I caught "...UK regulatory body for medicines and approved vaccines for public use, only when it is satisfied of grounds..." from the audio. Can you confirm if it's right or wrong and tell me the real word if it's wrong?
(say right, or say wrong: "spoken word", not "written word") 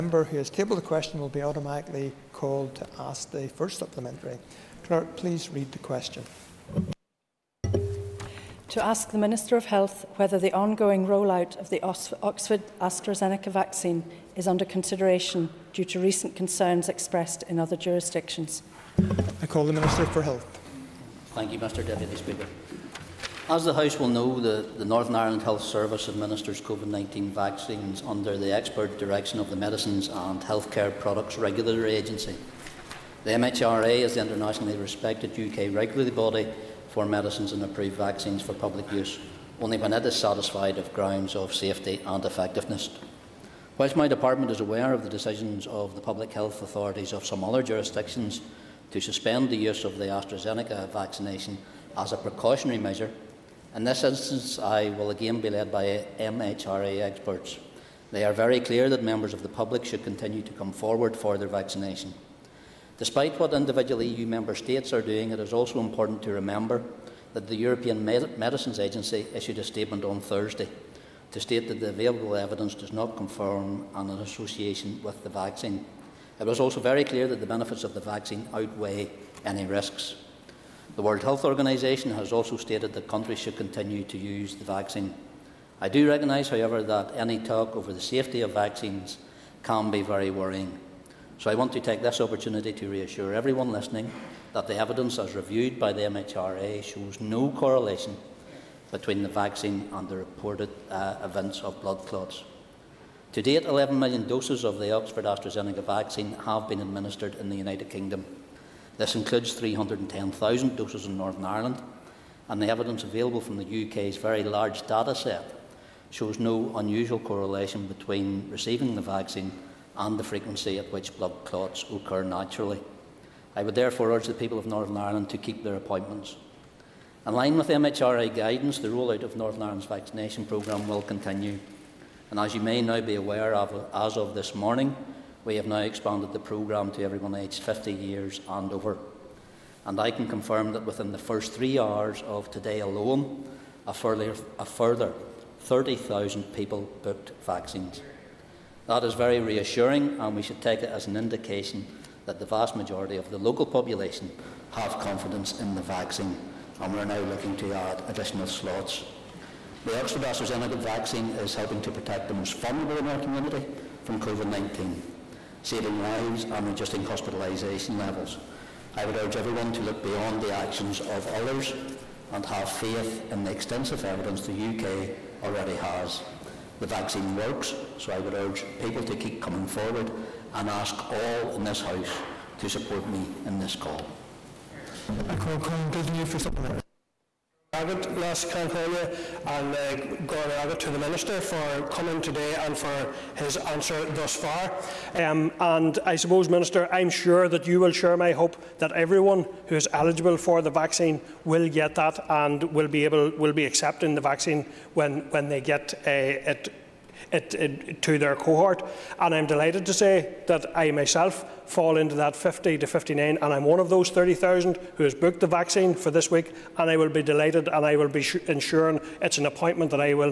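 right.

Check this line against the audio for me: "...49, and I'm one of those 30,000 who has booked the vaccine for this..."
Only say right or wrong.
wrong.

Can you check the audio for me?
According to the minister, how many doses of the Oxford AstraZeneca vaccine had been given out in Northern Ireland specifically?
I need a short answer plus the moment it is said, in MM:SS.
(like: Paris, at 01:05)
310,000, at 01:49.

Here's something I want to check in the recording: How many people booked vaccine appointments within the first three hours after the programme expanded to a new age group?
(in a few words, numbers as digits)
30,000.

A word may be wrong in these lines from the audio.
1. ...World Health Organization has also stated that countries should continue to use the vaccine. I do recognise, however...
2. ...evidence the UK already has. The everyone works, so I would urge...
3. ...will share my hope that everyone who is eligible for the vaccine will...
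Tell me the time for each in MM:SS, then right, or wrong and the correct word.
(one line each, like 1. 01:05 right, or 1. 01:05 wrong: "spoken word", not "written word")
1. 01:21 right
2. 02:54 wrong: "vaccine", not "everyone"
3. 03:17 right.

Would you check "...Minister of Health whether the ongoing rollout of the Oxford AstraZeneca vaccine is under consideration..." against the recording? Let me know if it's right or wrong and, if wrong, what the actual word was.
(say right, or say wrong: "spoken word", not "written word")
right.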